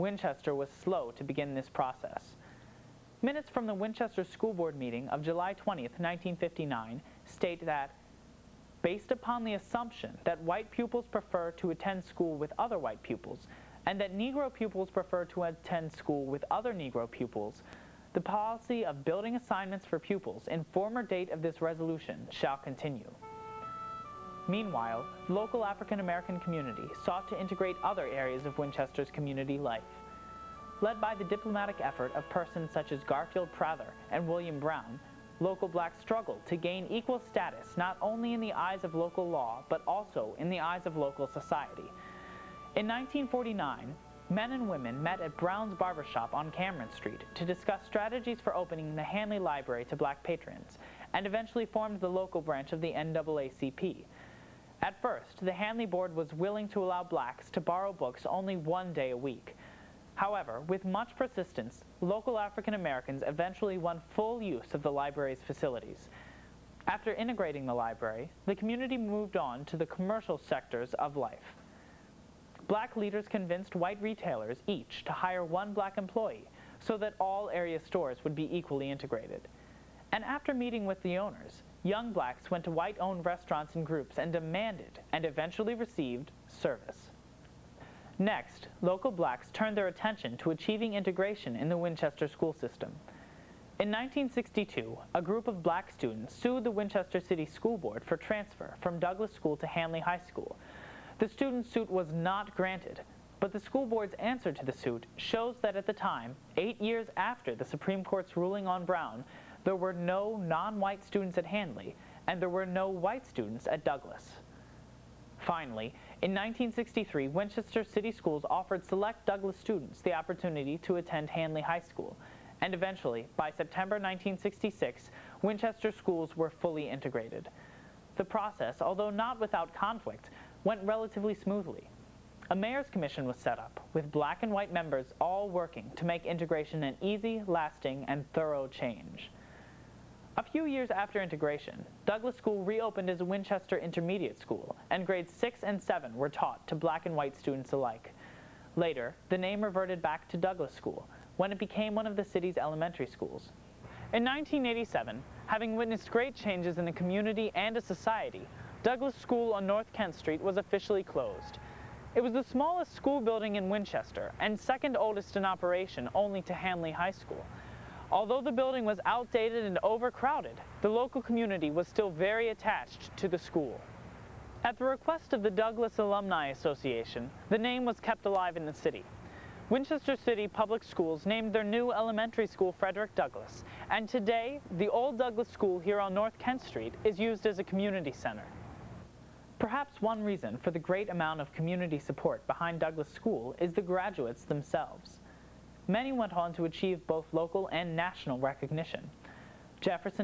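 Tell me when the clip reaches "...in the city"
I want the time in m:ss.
2:58.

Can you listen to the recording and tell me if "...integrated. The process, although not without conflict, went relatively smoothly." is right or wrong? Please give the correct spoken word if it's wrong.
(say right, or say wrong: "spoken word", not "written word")
right.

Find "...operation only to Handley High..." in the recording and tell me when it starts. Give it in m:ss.
2:45.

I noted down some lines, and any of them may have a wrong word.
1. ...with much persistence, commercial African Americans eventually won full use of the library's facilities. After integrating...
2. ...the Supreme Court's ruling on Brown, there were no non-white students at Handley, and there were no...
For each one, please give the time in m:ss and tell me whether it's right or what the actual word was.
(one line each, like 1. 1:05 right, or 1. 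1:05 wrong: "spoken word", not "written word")
1. 1:00 wrong: "local", not "commercial"
2. 1:47 right.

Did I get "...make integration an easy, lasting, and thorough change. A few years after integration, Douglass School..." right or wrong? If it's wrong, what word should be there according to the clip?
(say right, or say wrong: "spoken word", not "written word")
right.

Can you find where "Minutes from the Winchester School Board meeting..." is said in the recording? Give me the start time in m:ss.
0:03.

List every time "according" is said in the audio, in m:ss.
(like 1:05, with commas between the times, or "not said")
not said.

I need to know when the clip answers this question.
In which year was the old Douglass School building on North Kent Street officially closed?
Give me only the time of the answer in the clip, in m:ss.
2:34.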